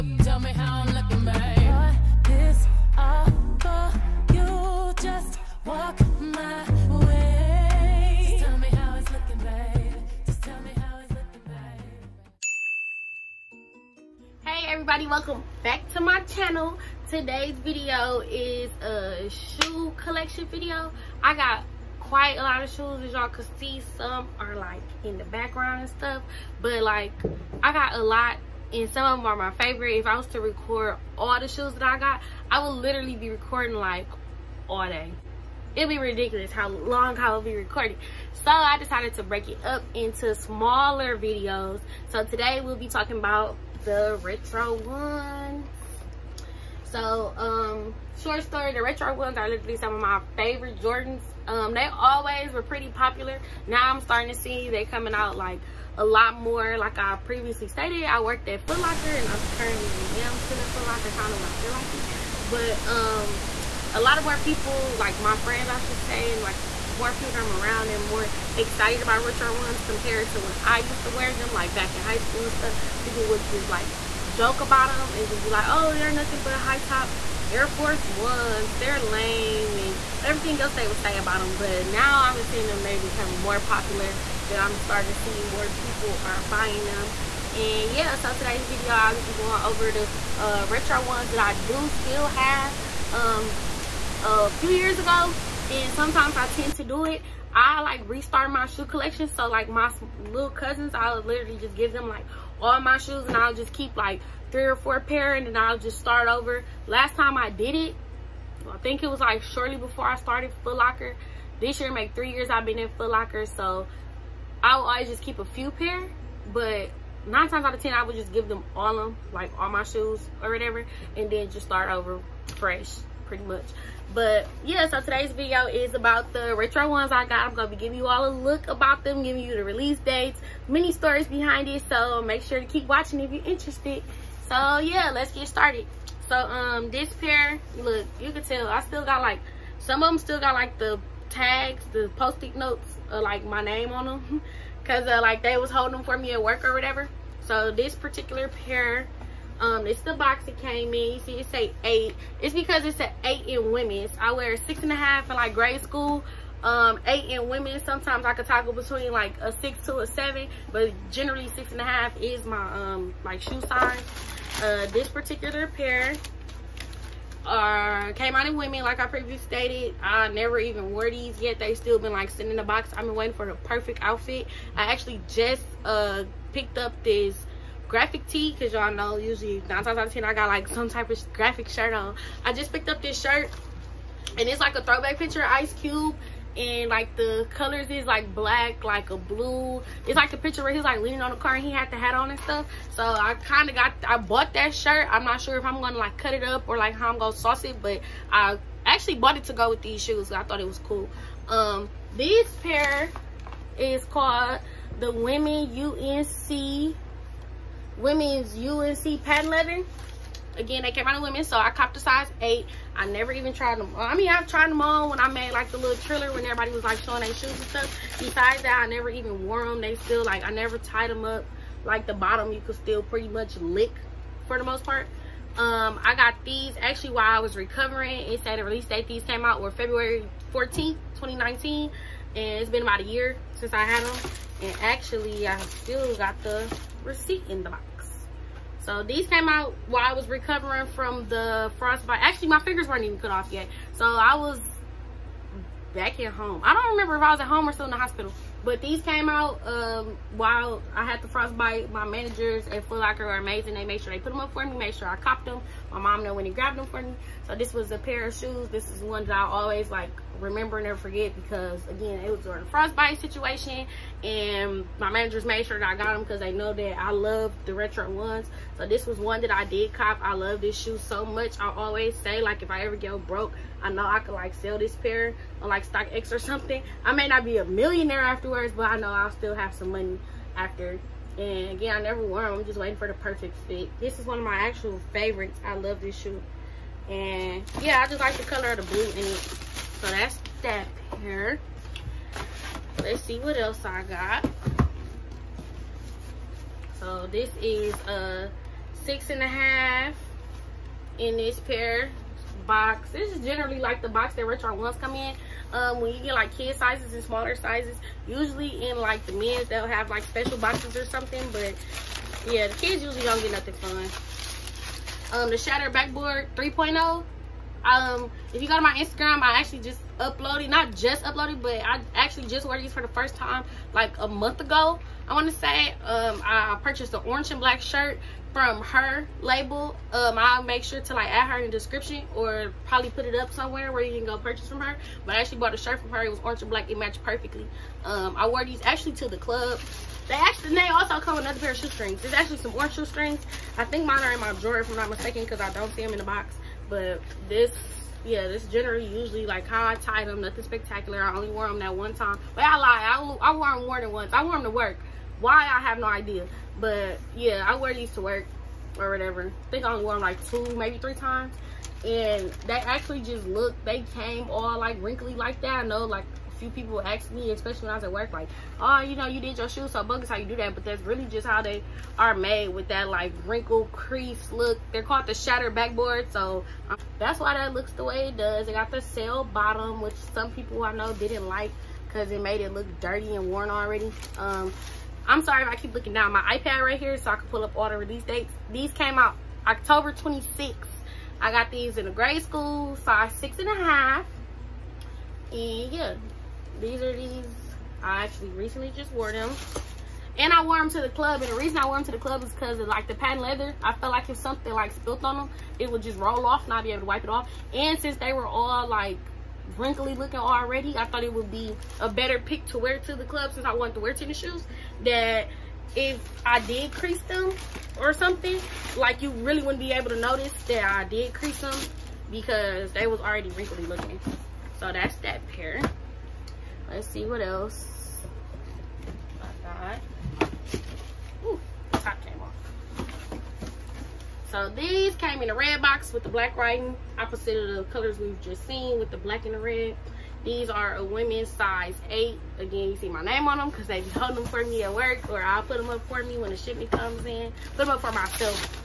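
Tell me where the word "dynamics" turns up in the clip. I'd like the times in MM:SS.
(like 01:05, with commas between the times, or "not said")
not said.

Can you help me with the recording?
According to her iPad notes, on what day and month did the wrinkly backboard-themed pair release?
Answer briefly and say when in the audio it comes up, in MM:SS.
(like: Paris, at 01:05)
October 26, at 06:29.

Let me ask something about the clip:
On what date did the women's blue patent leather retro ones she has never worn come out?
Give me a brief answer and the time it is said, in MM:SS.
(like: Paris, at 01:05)
February 14, 2019, at 03:49.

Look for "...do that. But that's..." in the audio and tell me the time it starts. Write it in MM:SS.
06:10.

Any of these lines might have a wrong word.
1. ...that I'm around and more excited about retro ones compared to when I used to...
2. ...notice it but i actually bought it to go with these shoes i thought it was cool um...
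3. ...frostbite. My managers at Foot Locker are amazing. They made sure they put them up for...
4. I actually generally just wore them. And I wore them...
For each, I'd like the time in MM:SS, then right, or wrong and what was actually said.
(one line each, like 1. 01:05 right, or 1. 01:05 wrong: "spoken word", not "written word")
1. 01:07 right
2. 03:17 wrong: "sauce", not "notice"
3. 04:11 right
4. 06:38 wrong: "recently", not "generally".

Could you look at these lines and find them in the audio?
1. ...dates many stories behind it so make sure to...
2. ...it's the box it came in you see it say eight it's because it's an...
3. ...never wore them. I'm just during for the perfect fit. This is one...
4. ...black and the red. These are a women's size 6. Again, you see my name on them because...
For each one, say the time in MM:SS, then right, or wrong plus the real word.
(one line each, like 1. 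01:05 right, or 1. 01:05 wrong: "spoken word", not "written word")
1. 02:09 right
2. 02:29 right
3. 04:41 wrong: "waiting", not "during"
4. 07:19 wrong: "8", not "6".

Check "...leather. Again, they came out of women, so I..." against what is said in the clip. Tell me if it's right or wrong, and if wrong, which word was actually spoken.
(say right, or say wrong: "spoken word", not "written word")
right.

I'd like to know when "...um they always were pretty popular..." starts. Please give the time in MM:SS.
00:51.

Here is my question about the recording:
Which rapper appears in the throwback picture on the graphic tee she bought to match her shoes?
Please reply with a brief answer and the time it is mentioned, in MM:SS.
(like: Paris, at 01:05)
Ice Cube, at 03:05.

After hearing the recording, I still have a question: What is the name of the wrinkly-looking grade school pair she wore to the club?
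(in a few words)
Shatter Backboard 3.0.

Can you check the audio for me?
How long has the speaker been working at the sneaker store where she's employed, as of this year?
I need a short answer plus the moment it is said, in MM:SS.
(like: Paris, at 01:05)
3 years, at 01:52.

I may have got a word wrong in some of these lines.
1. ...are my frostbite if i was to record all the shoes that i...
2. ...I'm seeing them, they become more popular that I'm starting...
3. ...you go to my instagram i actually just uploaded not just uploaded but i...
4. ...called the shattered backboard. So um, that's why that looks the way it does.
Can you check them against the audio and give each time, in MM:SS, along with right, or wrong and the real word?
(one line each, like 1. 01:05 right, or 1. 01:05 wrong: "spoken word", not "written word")
1. 00:29 wrong: "favorite", not "frostbite"
2. 01:22 right
3. 05:18 right
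4. 06:15 right.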